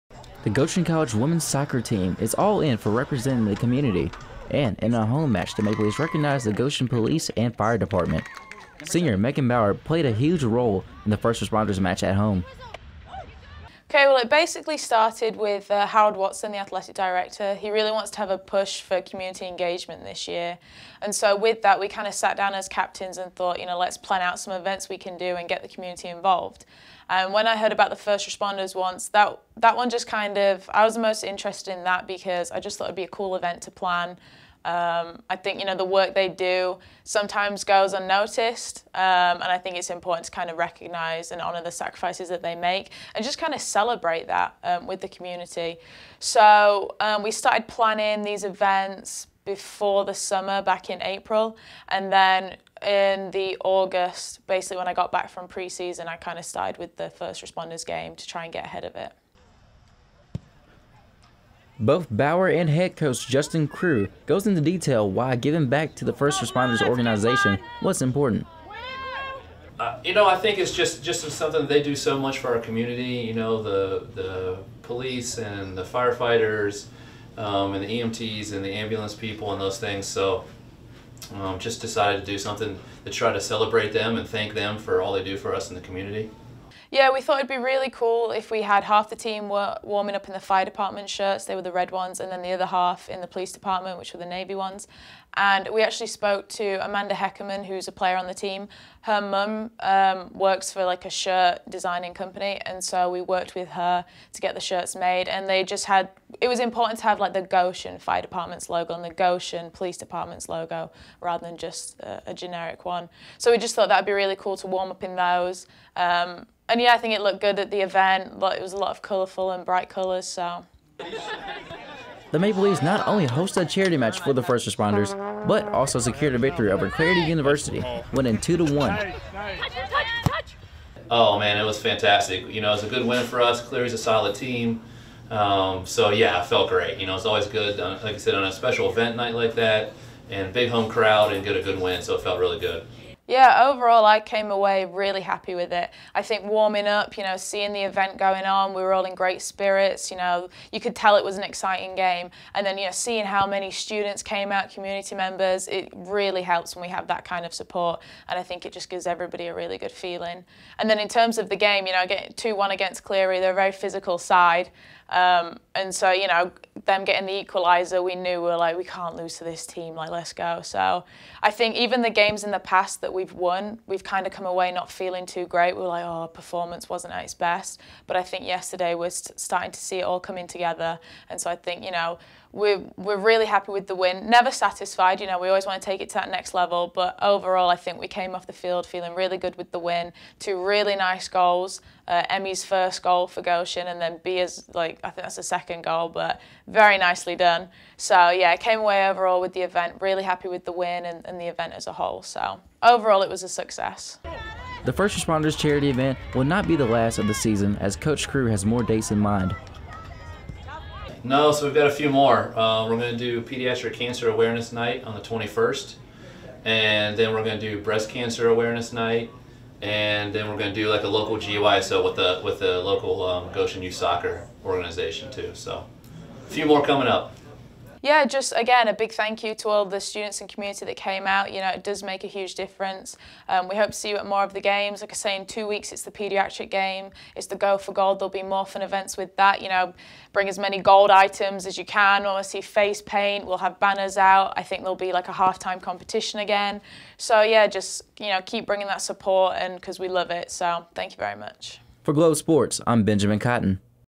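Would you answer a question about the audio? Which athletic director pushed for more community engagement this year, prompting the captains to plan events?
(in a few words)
Harold Watson.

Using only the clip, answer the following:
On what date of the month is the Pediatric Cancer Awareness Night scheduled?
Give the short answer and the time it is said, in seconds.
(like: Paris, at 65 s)
21st, at 215 s.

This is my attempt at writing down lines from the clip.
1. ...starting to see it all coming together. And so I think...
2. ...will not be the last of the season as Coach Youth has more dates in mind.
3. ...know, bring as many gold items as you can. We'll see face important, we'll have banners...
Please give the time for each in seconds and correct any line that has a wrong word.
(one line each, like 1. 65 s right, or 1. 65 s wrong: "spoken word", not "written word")
1. 179 s right
2. 206 s wrong: "Crew", not "Youth"
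3. 239 s wrong: "paint", not "important".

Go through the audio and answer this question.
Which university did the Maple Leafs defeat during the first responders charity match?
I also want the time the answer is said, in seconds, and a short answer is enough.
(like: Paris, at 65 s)
Cleary University, at 126 s.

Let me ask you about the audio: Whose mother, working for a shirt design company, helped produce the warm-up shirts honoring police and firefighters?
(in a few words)
Amanda Heckerman.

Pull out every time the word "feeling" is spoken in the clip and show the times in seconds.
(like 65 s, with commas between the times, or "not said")
159 s, 174 s, 188 s.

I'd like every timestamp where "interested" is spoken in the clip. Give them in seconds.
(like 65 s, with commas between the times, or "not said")
31 s.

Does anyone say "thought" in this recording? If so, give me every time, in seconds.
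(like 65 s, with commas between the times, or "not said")
23 s, 32 s, 87 s, 113 s.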